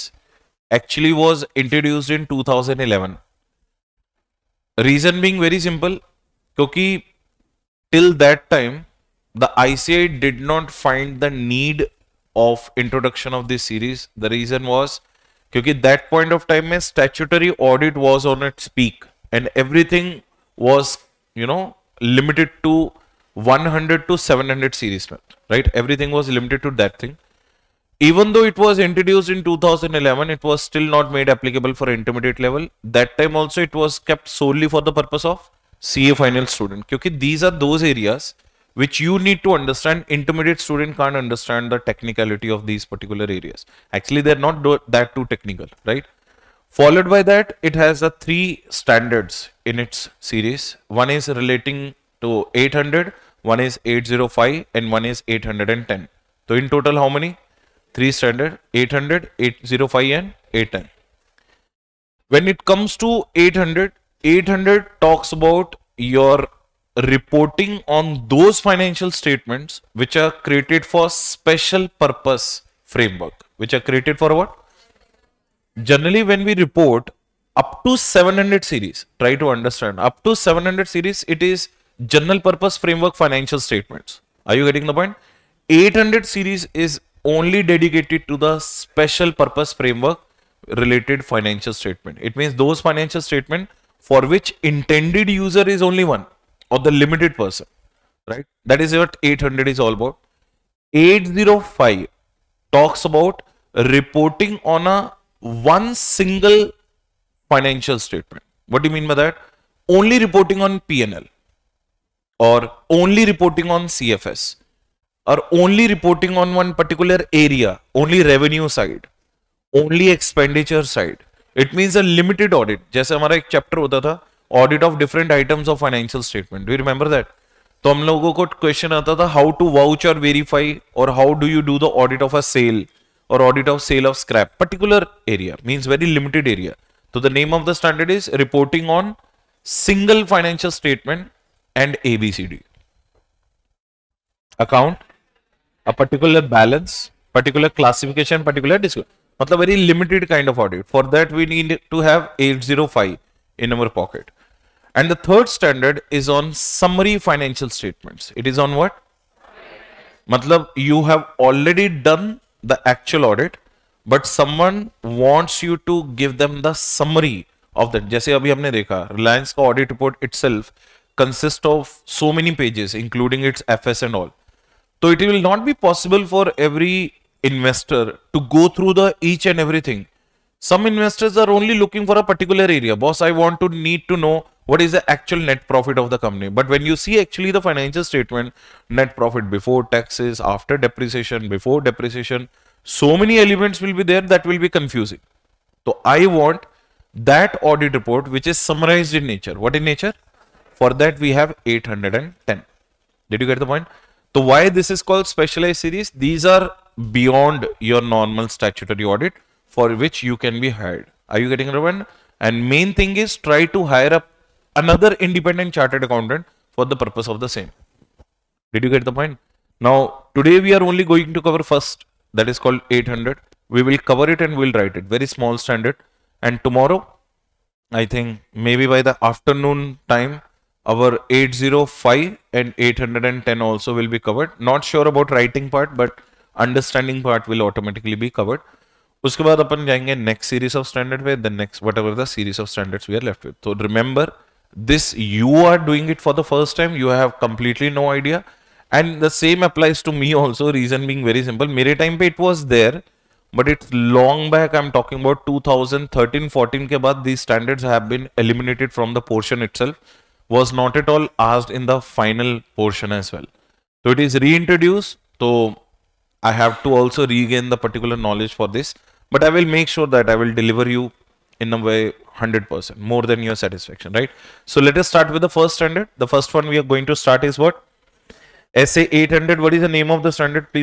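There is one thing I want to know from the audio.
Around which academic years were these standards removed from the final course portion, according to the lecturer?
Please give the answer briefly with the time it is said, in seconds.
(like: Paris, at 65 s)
2013-14, at 255 s.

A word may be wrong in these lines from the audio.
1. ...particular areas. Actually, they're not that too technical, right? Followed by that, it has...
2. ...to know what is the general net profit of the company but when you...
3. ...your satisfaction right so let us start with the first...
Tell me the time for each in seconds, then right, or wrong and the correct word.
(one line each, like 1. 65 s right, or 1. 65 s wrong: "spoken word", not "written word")
1. 42 s right
2. 184 s wrong: "actual", not "general"
3. 273 s right.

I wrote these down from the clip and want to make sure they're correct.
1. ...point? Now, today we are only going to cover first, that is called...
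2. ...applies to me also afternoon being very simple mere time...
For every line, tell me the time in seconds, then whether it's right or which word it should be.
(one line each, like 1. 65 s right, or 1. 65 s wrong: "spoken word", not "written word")
1. 219 s right
2. 249 s wrong: "reason", not "afternoon".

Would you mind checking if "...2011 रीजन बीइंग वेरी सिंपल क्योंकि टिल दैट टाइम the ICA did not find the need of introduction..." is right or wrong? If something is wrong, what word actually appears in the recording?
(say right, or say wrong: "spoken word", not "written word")
right.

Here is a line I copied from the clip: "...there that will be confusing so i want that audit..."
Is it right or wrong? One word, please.
right.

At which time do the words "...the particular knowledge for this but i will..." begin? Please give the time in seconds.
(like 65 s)
267 s.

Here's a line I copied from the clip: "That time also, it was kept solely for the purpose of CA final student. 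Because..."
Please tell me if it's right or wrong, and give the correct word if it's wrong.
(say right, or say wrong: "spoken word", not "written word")
right.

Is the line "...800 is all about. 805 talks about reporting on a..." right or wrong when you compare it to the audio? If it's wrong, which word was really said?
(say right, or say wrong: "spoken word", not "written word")
right.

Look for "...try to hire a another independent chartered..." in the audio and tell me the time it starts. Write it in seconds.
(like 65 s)
213 s.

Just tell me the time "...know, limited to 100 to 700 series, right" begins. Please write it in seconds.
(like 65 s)
21 s.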